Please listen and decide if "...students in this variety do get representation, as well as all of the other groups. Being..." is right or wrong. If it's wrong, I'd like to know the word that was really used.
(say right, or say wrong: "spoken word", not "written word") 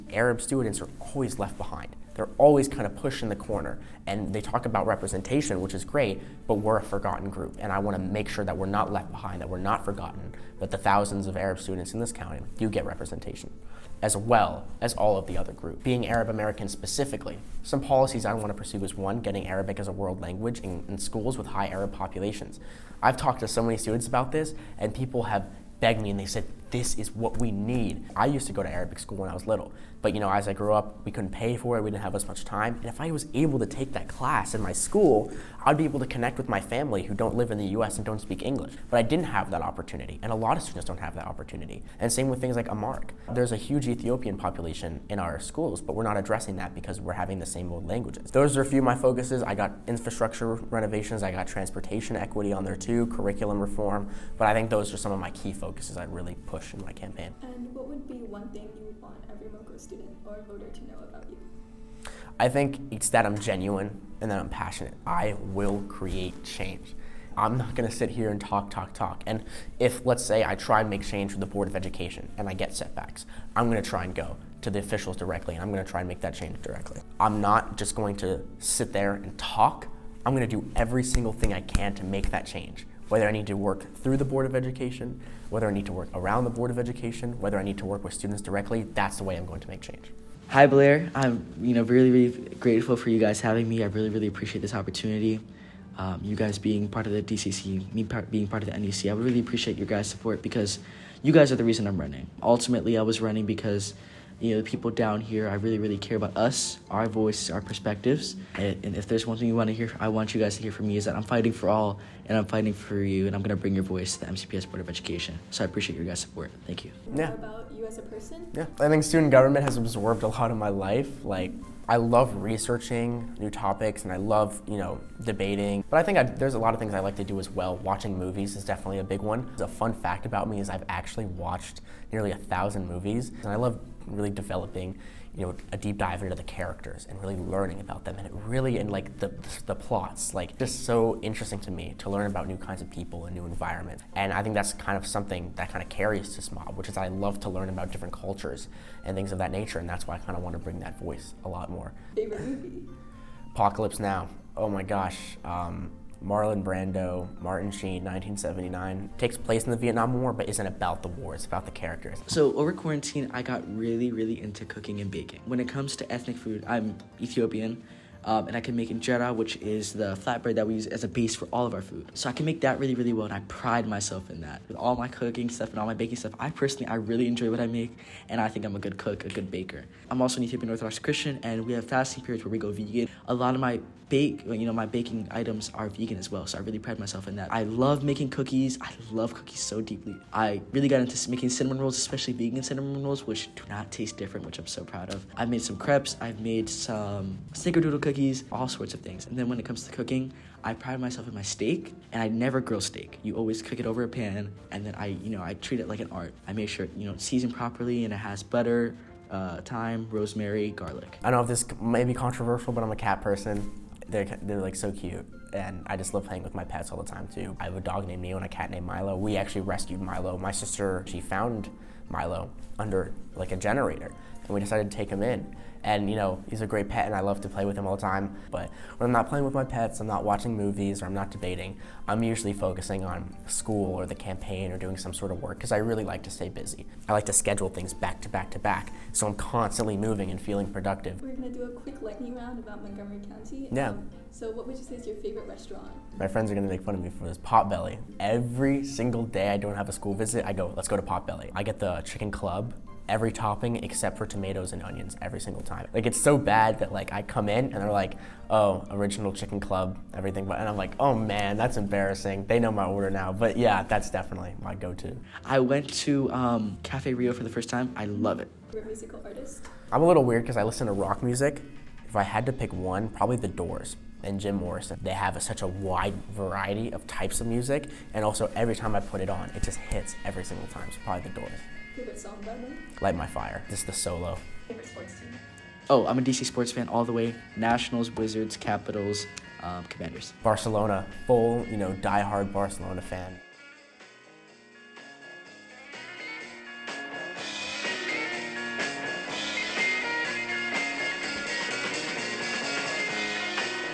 wrong: "county", not "variety".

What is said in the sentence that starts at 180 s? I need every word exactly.
I'm also an Ethiopian Orthodox Christian, and we have fasting periods where we go vegan.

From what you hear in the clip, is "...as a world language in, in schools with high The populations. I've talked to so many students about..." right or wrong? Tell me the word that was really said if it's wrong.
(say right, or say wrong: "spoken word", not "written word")
wrong: "Arab", not "The".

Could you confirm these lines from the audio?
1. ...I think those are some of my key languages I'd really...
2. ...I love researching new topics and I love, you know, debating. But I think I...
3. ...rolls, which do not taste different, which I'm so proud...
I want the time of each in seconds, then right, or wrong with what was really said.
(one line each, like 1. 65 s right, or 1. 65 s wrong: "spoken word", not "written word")
1. 54 s wrong: "focuses", not "languages"
2. 121 s right
3. 193 s right.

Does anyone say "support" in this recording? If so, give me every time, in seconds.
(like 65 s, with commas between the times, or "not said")
100 s, 116 s.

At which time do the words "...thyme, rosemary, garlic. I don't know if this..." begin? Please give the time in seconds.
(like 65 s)
209 s.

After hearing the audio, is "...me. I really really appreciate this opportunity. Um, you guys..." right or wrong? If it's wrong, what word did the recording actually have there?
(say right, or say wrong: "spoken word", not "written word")
right.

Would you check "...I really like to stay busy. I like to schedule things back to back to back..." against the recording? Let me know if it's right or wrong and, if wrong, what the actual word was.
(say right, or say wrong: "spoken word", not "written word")
right.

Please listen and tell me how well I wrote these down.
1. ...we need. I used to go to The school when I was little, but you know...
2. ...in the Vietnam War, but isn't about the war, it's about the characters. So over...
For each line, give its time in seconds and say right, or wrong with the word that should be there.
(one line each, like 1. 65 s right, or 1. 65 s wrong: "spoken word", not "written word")
1. 27 s wrong: "Arabic", not "The"
2. 159 s right.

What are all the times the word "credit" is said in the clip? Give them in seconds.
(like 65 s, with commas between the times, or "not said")
not said.